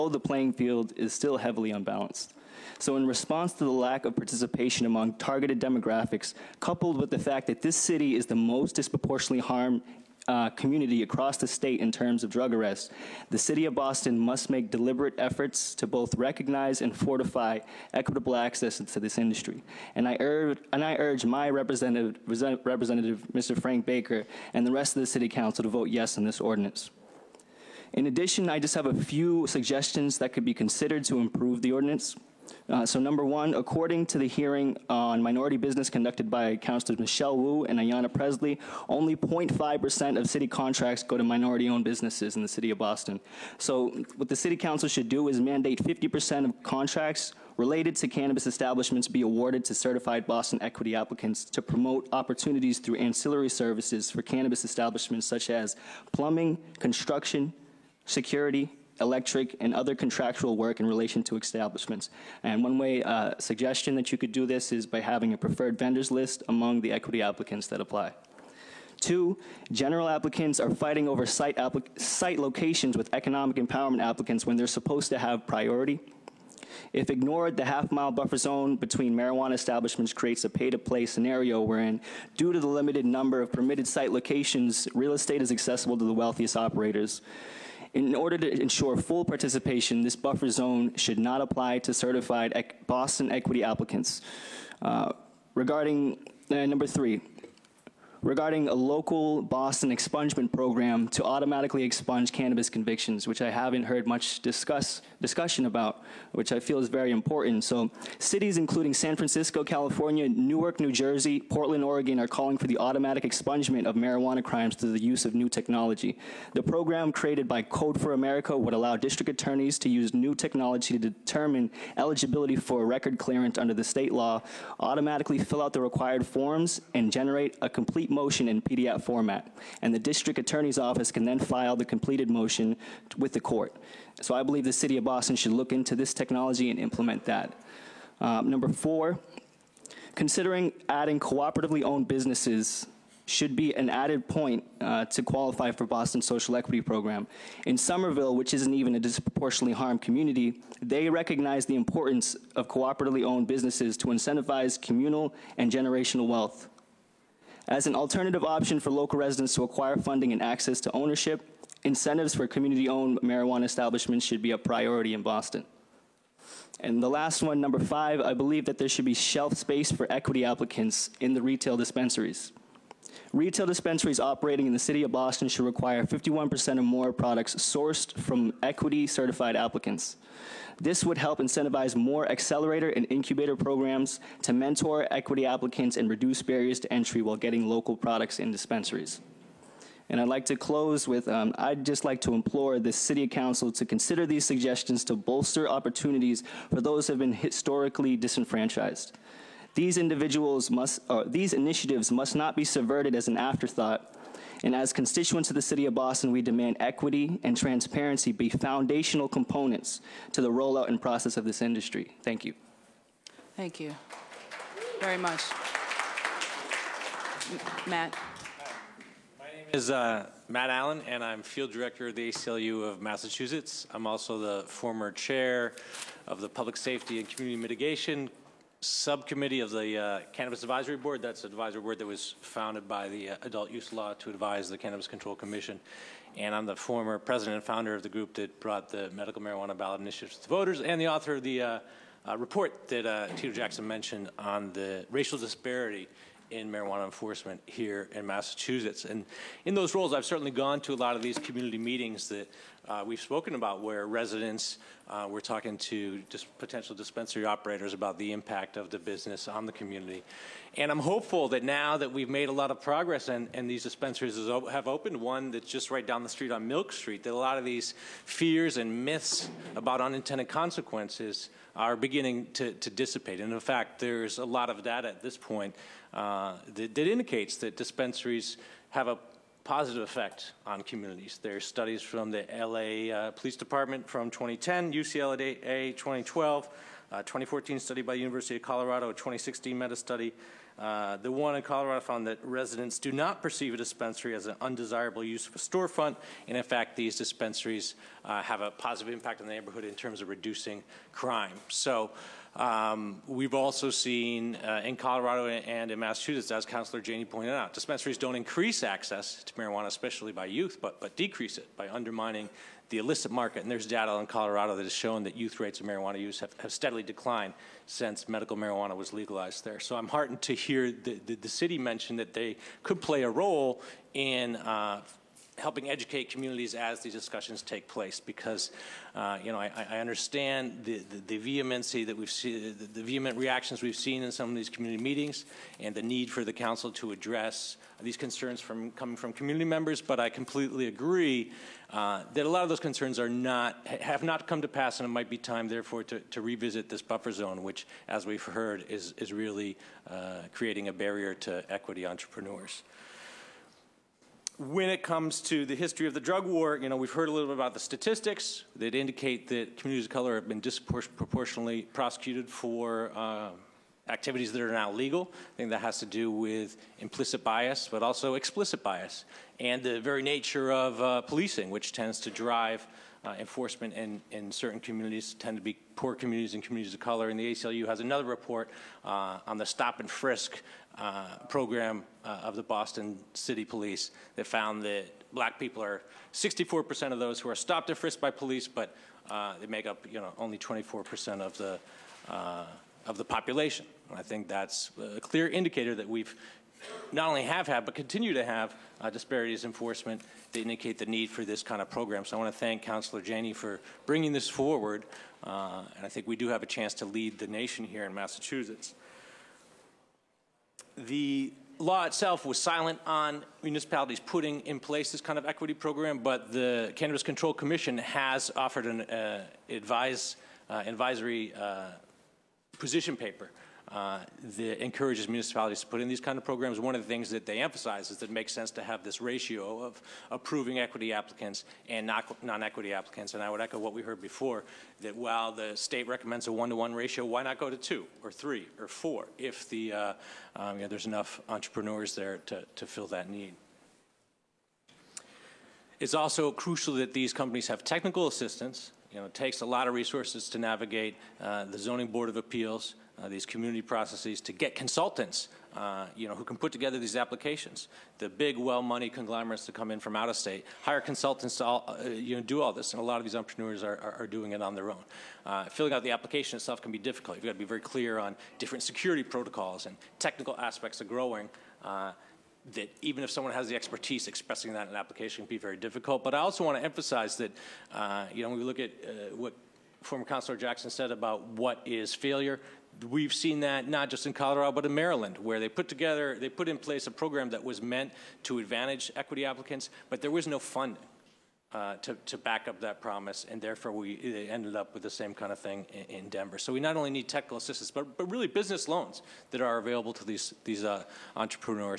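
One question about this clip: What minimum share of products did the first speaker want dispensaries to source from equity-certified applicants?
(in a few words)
51%.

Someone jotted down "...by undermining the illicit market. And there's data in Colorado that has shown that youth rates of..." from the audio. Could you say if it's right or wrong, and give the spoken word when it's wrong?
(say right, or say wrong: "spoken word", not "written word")
right.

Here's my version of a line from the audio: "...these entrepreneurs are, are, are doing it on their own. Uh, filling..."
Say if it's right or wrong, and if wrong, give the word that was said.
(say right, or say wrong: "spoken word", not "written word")
right.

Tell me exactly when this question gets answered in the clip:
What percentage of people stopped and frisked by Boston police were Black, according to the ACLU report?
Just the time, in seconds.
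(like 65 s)
386 s.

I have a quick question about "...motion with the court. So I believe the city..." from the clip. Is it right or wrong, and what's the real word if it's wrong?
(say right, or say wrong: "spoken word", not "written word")
right.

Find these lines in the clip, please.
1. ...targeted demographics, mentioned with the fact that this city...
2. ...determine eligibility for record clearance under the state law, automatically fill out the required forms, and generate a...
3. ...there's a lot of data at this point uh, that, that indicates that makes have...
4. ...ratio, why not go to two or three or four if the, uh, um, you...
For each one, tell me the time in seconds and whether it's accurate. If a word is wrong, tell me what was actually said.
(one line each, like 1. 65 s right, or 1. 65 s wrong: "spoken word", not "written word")
1. 5 s wrong: "coupled", not "mentioned"
2. 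121 s right
3. 273 s wrong: "dispensaries", not "makes"
4. 436 s right.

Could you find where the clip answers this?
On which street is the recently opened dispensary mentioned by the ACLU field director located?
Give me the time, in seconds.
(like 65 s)
266 s.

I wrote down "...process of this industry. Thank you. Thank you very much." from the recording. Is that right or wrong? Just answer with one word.
right.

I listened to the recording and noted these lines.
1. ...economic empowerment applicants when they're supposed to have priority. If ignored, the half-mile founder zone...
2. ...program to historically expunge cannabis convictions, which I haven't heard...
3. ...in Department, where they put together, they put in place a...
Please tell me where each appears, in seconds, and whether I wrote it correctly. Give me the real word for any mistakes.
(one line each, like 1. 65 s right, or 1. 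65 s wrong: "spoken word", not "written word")
1. 73 s wrong: "buffer", not "founder"
2. 100 s wrong: "automatically", not "historically"
3. 484 s wrong: "Maryland", not "Department".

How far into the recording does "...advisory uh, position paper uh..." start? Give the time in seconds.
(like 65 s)
420 s.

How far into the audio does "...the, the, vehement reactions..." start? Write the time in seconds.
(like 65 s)
332 s.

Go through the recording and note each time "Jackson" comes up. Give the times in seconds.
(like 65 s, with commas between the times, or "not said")
243 s, 480 s.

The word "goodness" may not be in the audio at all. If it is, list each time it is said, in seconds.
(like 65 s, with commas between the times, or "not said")
not said.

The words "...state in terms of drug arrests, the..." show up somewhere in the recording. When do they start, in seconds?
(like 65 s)
11 s.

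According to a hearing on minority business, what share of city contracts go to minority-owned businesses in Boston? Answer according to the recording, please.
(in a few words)
0.5%.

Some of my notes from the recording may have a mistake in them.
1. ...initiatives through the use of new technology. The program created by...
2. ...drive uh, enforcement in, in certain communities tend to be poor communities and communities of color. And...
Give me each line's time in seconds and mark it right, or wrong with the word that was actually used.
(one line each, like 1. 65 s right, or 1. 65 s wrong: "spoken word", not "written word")
1. 114 s wrong: "crimes", not "initiatives"
2. 372 s right.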